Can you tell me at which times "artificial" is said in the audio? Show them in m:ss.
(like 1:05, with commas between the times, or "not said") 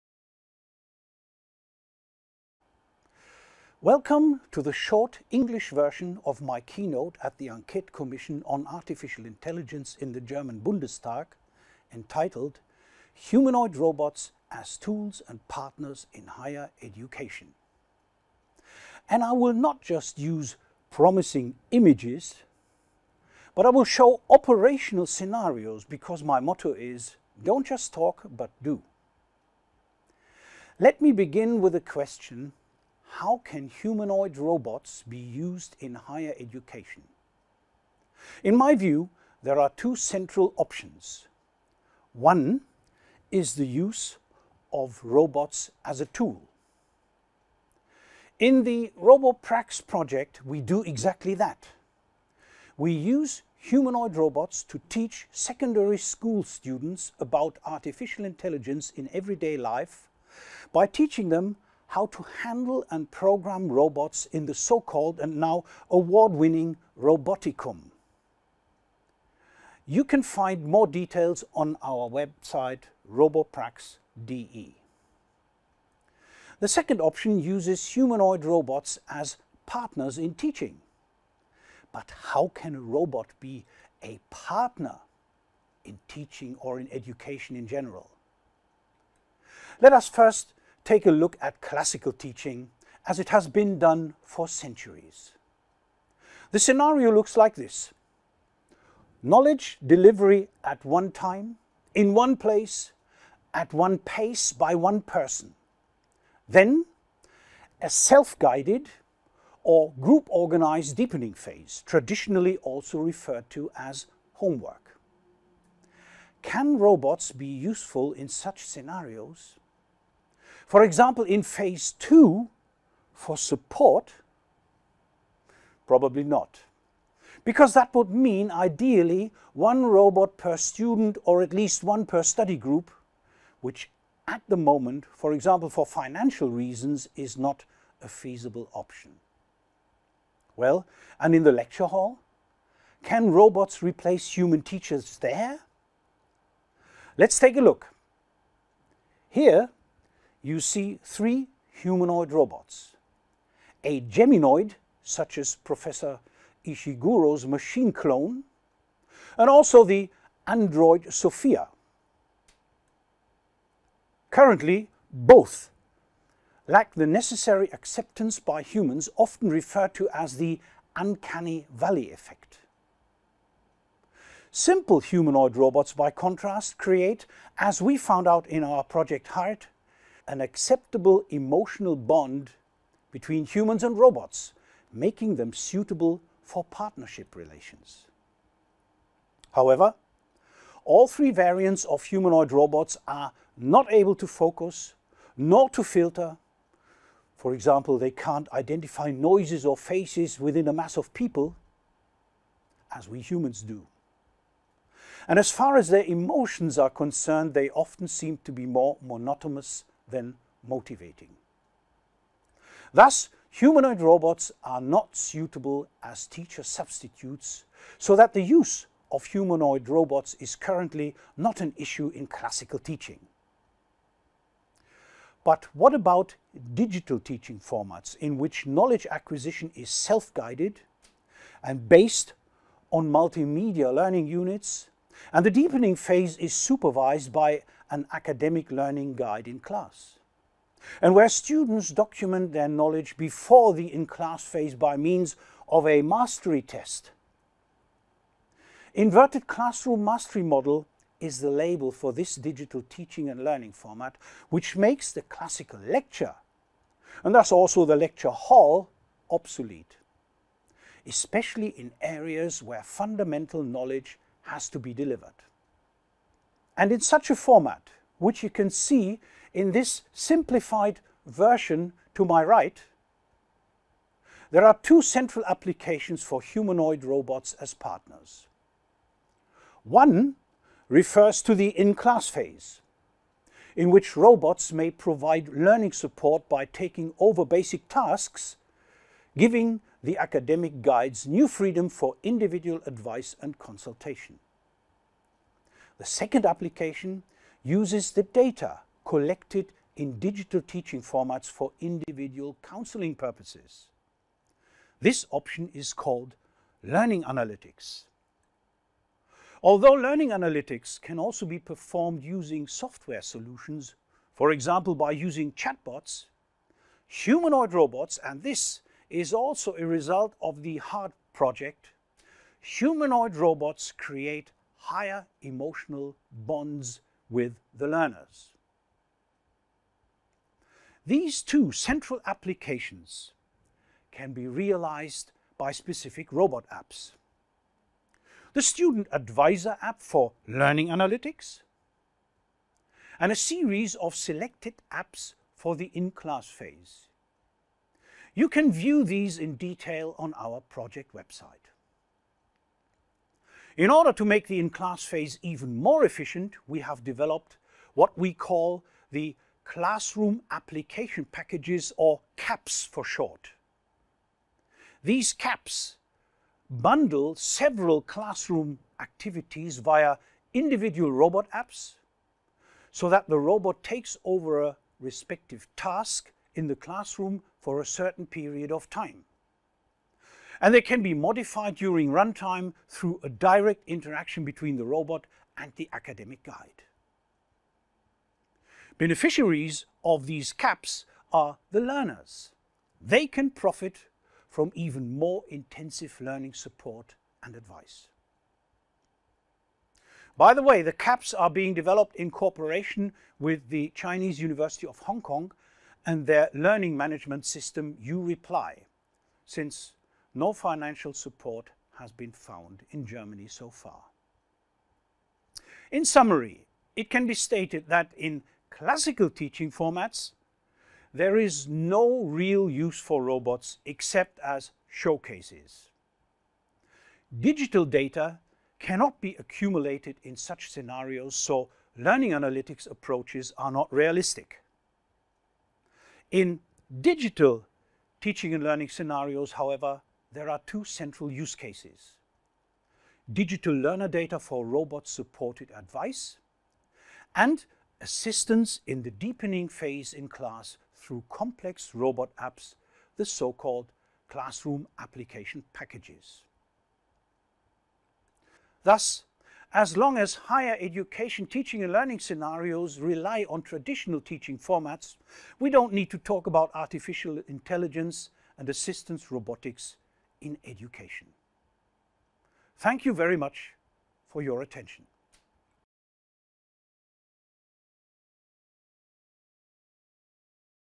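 0:08, 0:57, 7:46.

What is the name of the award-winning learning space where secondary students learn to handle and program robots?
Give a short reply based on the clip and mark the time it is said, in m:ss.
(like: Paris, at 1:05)
Roboticum, at 1:06.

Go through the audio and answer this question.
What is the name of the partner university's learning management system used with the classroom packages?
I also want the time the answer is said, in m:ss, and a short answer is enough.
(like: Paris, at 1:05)
UReply, at 6:48.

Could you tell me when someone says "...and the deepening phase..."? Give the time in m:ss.
3:55.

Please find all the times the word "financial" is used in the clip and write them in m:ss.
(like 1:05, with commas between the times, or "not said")
2:15, 6:50.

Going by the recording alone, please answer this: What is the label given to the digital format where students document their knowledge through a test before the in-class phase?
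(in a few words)
Inverted classroom mastery model.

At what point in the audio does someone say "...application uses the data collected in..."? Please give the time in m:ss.
4:56.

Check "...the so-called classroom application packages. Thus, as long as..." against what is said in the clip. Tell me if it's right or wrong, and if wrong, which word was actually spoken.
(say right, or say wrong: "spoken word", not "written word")
right.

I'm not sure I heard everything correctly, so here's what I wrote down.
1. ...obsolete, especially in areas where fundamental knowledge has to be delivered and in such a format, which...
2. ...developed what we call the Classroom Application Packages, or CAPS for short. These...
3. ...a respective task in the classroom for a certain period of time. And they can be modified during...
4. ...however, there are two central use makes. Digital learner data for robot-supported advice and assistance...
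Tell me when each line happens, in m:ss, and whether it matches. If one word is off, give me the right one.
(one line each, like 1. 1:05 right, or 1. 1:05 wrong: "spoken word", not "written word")
1. 4:19 right
2. 5:57 right
3. 6:14 right
4. 7:19 wrong: "cases", not "makes".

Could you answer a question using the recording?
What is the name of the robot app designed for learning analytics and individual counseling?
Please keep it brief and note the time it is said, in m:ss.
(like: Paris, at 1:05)
Student Advisor, at 5:38.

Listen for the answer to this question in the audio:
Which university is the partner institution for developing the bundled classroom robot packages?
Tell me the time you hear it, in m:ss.
6:43.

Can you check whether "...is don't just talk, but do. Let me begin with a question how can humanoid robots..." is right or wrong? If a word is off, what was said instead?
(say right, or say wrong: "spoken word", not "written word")
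right.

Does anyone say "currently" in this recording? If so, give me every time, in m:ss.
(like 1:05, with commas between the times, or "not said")
2:44, 3:40.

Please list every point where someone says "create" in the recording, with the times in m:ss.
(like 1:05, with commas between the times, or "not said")
2:56, 5:23.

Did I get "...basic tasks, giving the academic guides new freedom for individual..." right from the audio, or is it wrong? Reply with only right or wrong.
right.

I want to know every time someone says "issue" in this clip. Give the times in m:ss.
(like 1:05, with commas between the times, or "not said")
3:41.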